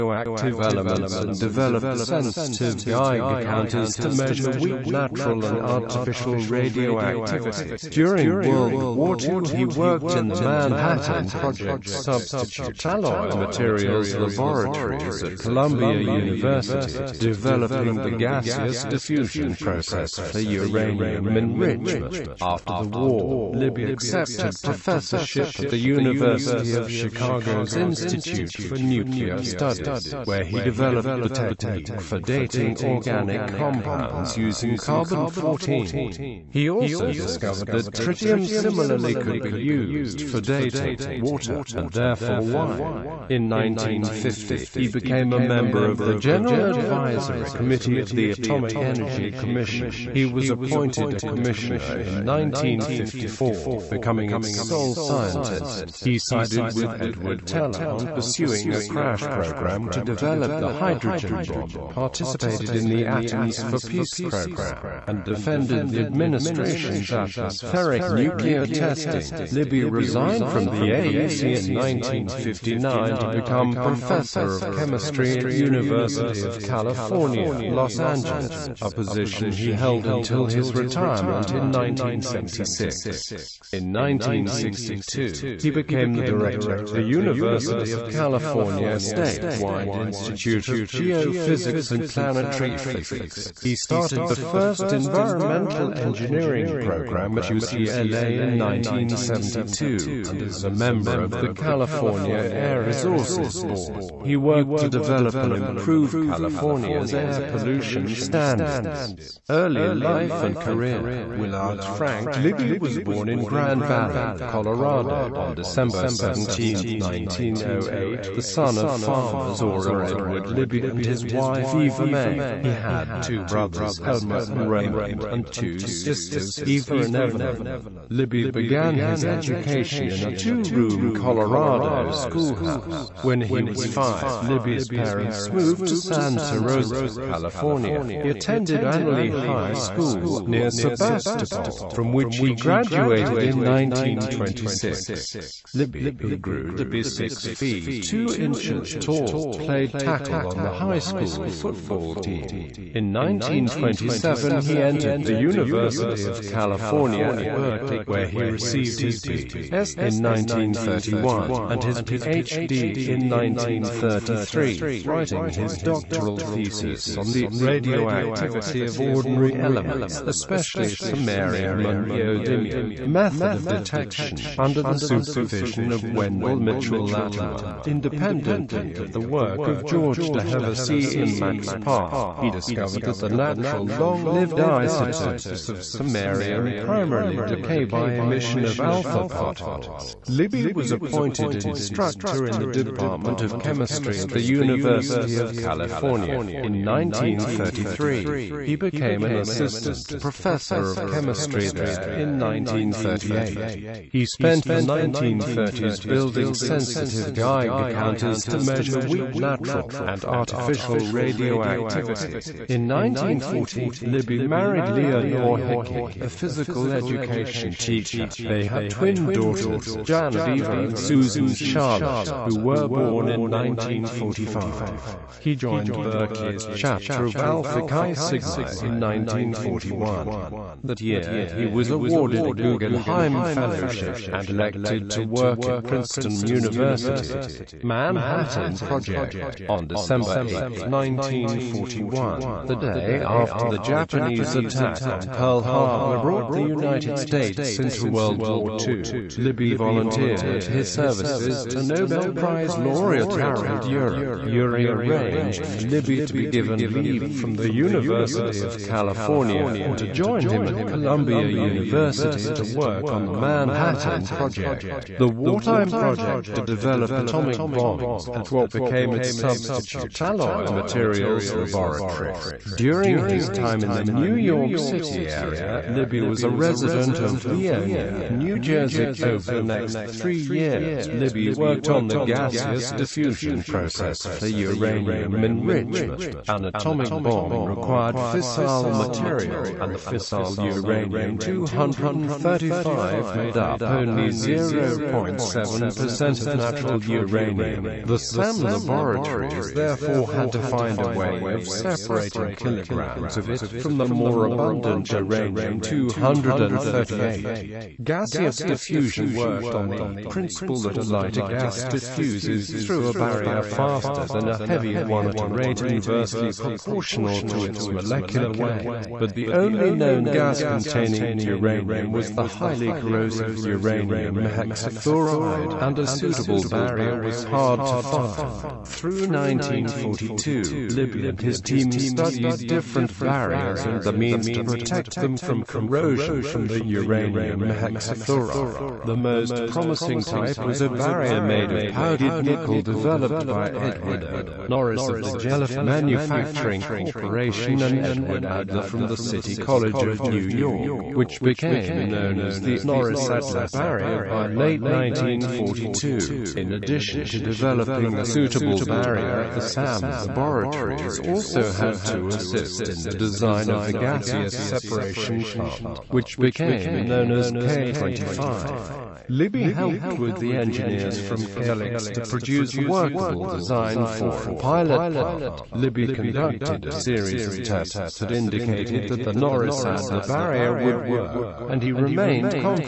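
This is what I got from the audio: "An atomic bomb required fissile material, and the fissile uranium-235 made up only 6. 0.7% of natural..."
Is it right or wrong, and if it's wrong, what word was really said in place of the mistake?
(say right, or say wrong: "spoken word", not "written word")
wrong: "0", not "6".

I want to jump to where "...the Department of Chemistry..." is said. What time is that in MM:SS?
03:12.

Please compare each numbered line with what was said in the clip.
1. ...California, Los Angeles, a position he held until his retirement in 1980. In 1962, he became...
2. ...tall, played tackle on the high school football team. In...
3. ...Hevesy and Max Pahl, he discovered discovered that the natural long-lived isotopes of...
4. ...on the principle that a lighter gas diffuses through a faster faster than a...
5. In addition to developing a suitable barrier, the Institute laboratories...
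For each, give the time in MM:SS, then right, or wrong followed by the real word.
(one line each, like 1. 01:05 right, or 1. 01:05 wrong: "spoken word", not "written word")
1. 01:16 wrong: "1976", not "1980"
2. 02:28 right
3. 03:00 right
4. 05:09 wrong: "barrier", not "faster"
5. 05:56 wrong: "SAM", not "Institute".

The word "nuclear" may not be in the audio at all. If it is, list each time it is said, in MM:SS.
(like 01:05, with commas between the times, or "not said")
00:28, 01:08.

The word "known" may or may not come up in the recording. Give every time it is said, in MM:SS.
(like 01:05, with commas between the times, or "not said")
05:19, 05:52, 06:07.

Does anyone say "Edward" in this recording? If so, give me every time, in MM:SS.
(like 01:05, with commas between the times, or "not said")
00:56, 02:00, 05:43, 05:47.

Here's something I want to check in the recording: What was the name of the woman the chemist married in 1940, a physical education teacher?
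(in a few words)
Leonore Hickey.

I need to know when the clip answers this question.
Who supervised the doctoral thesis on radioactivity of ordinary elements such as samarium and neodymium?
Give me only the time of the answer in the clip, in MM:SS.
02:56.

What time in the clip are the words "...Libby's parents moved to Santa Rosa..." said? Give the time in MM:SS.
02:14.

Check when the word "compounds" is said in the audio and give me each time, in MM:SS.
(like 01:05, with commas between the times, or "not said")
00:33.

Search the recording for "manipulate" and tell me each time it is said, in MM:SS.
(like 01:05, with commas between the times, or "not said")
not said.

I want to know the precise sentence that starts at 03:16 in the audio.
In 1933, he became an assistant professor of chemistry there in 1938.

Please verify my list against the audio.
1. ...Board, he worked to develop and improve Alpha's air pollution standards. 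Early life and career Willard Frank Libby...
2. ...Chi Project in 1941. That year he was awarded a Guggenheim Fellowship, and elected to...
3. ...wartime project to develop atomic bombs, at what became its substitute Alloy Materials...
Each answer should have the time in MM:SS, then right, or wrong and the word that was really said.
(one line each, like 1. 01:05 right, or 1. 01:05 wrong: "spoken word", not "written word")
1. 01:43 wrong: "California", not "Alpha"
2. 03:47 wrong: "Sigma", not "Project"
3. 04:25 right.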